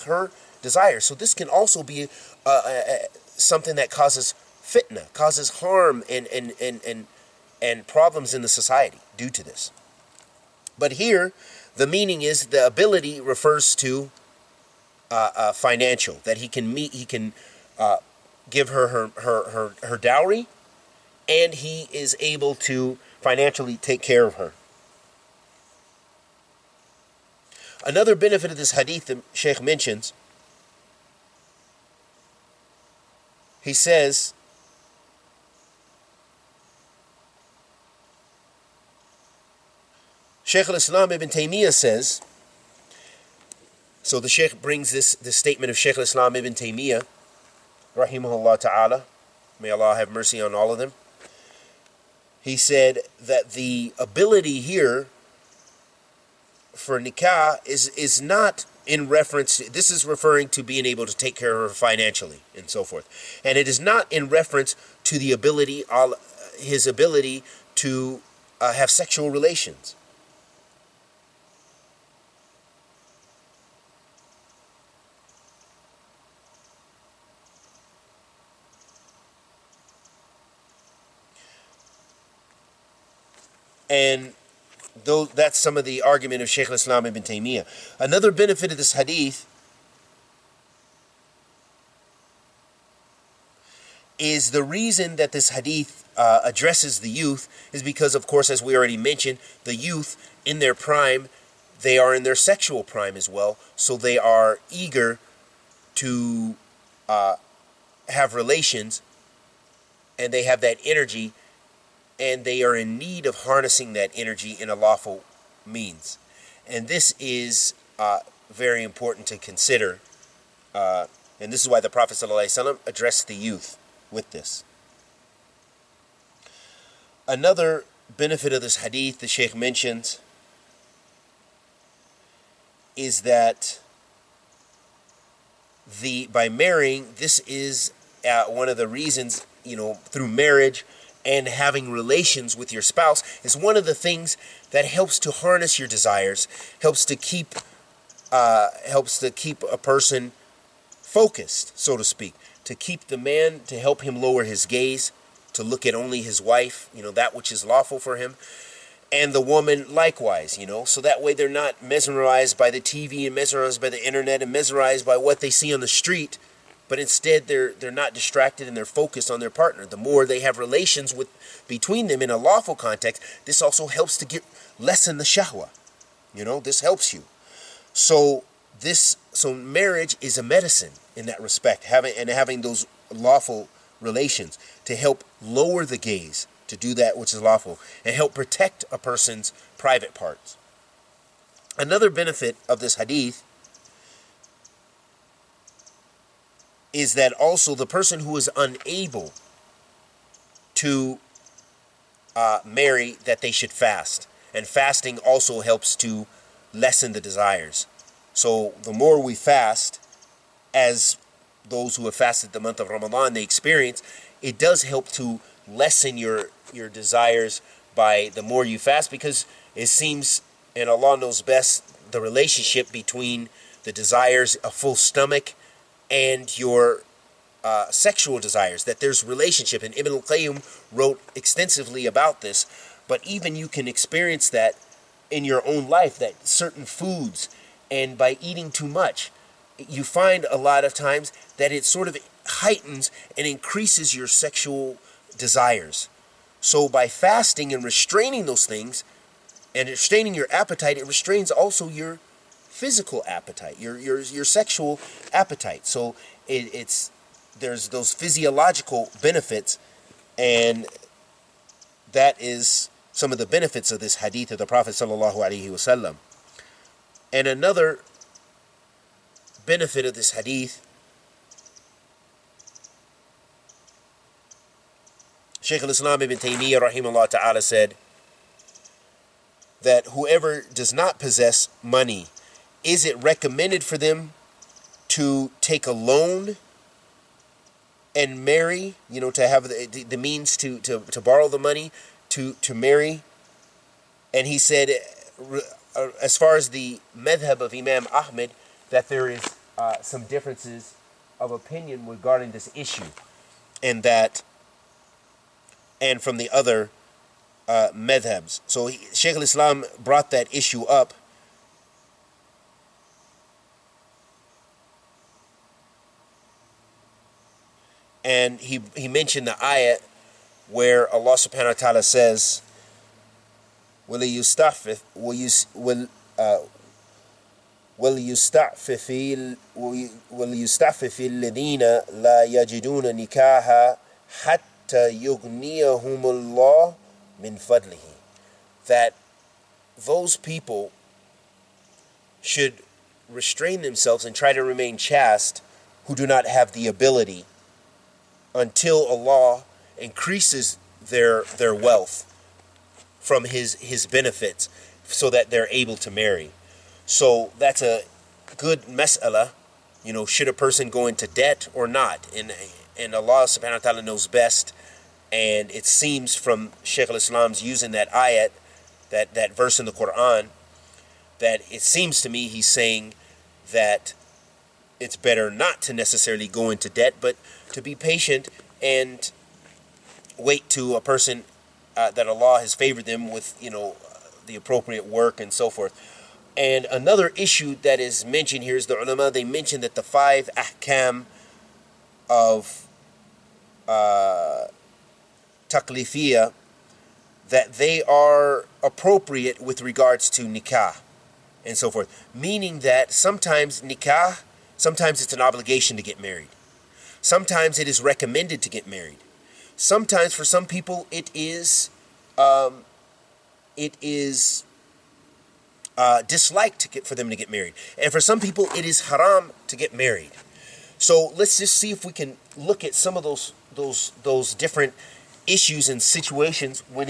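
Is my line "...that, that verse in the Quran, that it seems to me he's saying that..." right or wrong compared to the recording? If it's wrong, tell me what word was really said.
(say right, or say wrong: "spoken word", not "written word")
right.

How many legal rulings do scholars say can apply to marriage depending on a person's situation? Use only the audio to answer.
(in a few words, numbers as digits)
5.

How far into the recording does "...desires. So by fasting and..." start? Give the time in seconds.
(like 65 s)
245 s.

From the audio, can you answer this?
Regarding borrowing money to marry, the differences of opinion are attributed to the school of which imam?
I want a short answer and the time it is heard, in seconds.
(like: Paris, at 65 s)
Imam Ahmed, at 297 s.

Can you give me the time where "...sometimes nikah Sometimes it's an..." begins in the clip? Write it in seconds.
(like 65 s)
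403 s.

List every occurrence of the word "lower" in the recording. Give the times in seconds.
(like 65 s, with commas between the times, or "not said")
154 s, 185 s.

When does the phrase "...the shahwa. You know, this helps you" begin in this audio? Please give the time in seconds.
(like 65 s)
175 s.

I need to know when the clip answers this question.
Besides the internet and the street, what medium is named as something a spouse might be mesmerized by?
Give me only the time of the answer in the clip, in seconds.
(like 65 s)
162 s.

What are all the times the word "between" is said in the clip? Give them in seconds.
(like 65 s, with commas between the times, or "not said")
171 s, 222 s.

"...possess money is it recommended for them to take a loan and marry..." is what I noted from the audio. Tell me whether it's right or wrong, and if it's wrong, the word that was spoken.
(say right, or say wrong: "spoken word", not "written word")
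right.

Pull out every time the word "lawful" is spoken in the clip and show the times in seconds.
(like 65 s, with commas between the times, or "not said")
114 s, 157 s, 172 s, 183 s, 187 s.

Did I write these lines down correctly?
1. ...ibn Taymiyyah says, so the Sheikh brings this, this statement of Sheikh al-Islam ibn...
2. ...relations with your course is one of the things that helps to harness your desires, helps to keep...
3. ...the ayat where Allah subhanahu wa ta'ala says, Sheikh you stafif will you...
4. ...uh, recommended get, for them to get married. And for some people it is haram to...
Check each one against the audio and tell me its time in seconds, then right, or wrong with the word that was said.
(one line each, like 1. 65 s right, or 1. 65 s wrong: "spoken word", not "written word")
1. 41 s right
2. 141 s wrong: "spouse", not "course"
3. 319 s wrong: "Will", not "Sheikh"
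4. 415 s wrong: "disliked", not "recommended".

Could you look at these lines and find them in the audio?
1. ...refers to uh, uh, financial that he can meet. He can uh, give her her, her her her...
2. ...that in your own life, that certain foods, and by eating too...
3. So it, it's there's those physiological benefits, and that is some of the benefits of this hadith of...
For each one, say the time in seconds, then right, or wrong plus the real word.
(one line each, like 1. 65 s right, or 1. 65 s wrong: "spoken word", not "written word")
1. 13 s right
2. 234 s right
3. 255 s right.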